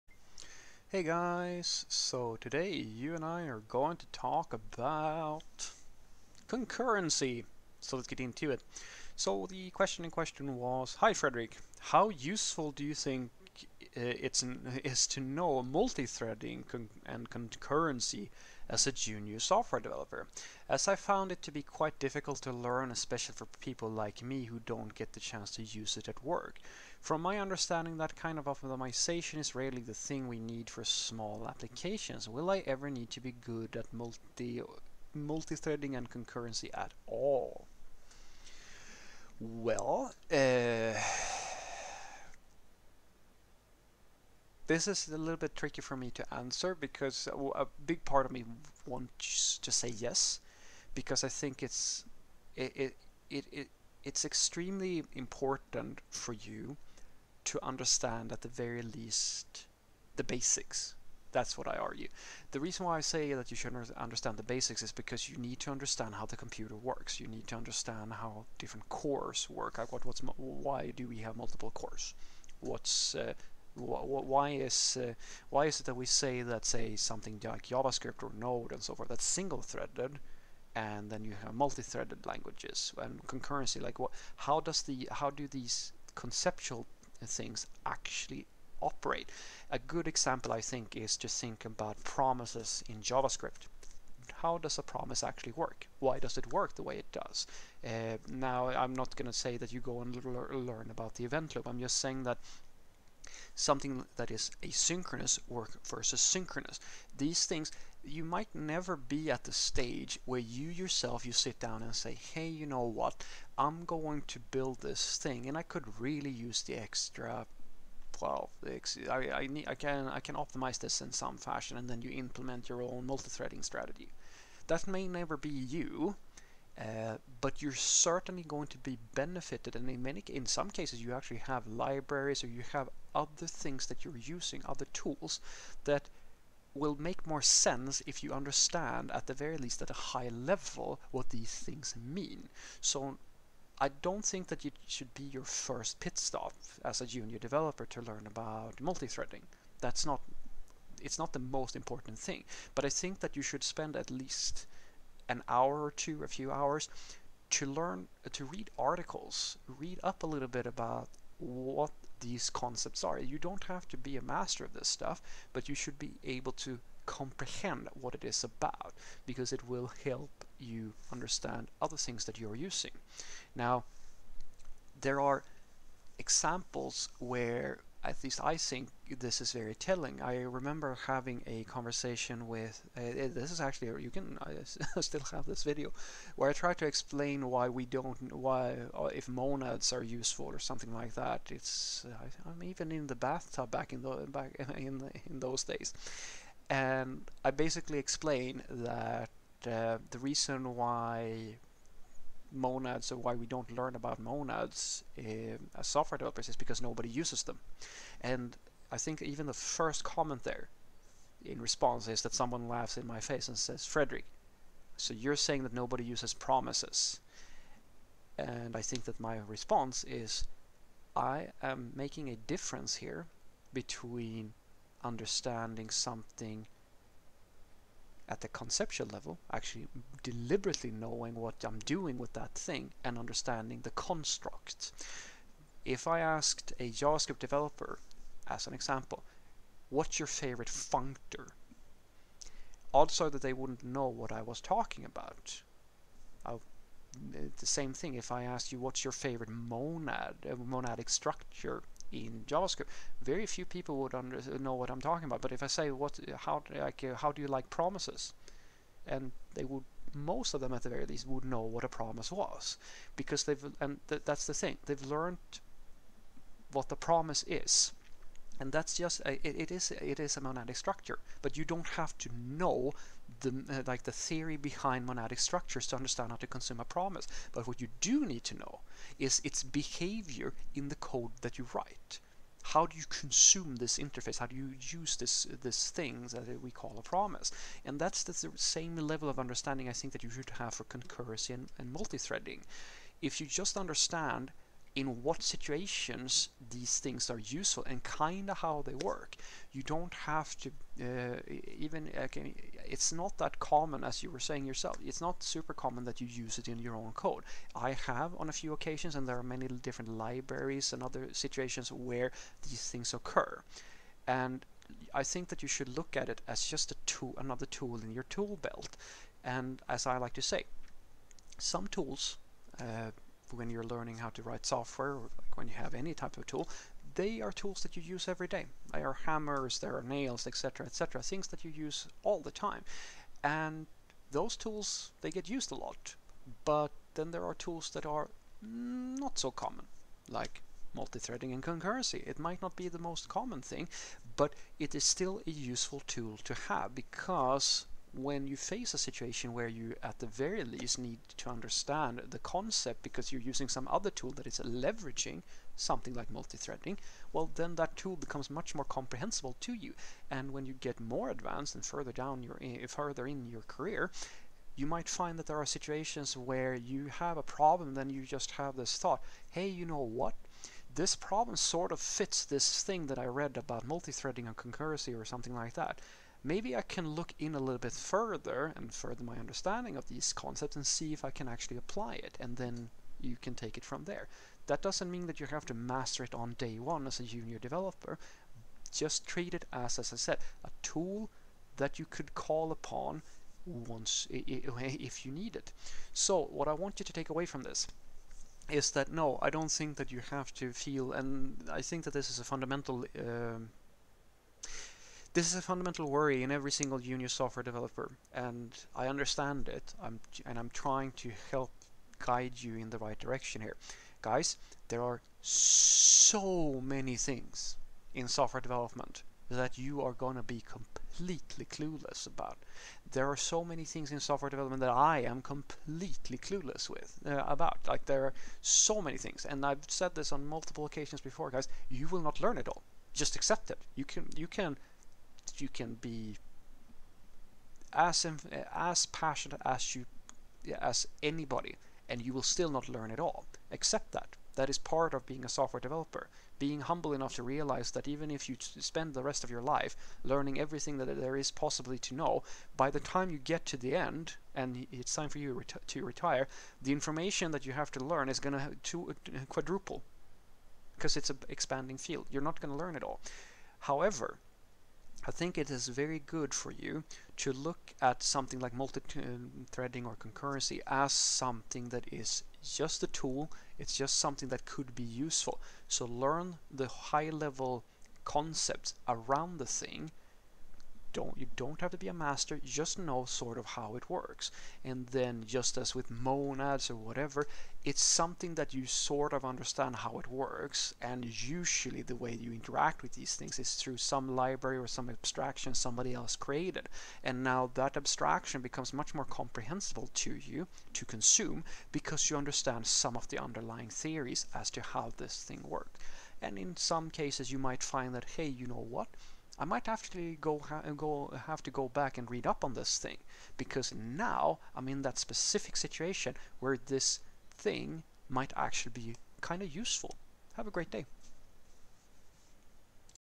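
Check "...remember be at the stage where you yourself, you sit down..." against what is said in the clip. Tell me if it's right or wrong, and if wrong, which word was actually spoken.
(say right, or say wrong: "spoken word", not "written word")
wrong: "never", not "remember".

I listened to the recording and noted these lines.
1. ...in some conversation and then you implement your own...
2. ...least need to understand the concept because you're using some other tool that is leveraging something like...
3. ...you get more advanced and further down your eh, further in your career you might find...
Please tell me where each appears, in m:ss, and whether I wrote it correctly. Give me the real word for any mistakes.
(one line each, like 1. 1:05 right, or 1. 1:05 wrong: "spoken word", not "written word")
1. 2:01 wrong: "fashion", not "conversation"
2. 5:50 right
3. 6:00 right.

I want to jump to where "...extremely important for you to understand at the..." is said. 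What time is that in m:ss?
0:54.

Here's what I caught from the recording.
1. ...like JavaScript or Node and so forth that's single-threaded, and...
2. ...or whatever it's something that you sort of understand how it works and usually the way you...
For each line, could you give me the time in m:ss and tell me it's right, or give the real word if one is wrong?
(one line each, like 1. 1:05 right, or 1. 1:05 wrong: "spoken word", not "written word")
1. 1:17 right
2. 8:06 right.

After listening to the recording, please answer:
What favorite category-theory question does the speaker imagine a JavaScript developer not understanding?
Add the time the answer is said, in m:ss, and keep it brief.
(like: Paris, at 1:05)
What's your favorite functor, at 3:59.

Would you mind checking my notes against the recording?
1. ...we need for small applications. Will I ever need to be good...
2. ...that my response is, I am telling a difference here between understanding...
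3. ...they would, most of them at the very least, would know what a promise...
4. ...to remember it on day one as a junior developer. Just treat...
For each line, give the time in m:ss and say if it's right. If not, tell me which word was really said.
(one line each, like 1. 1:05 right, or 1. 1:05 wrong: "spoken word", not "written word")
1. 0:30 right
2. 3:39 wrong: "making", not "telling"
3. 4:19 right
4. 6:25 wrong: "master", not "remember".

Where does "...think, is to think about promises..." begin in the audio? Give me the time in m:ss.
1:30.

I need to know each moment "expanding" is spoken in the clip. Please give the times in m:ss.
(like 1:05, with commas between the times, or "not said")
7:41.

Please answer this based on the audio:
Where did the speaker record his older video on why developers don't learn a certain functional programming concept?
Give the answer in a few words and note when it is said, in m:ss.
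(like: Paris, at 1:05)
In the bathtub, at 3:12.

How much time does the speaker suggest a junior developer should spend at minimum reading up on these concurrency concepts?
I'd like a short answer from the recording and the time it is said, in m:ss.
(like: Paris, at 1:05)
An hour or two, at 2:35.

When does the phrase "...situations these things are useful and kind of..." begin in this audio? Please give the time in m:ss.
4:55.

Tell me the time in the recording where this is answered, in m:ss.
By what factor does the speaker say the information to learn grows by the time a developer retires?
7:39.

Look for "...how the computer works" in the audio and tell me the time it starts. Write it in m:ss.
1:06.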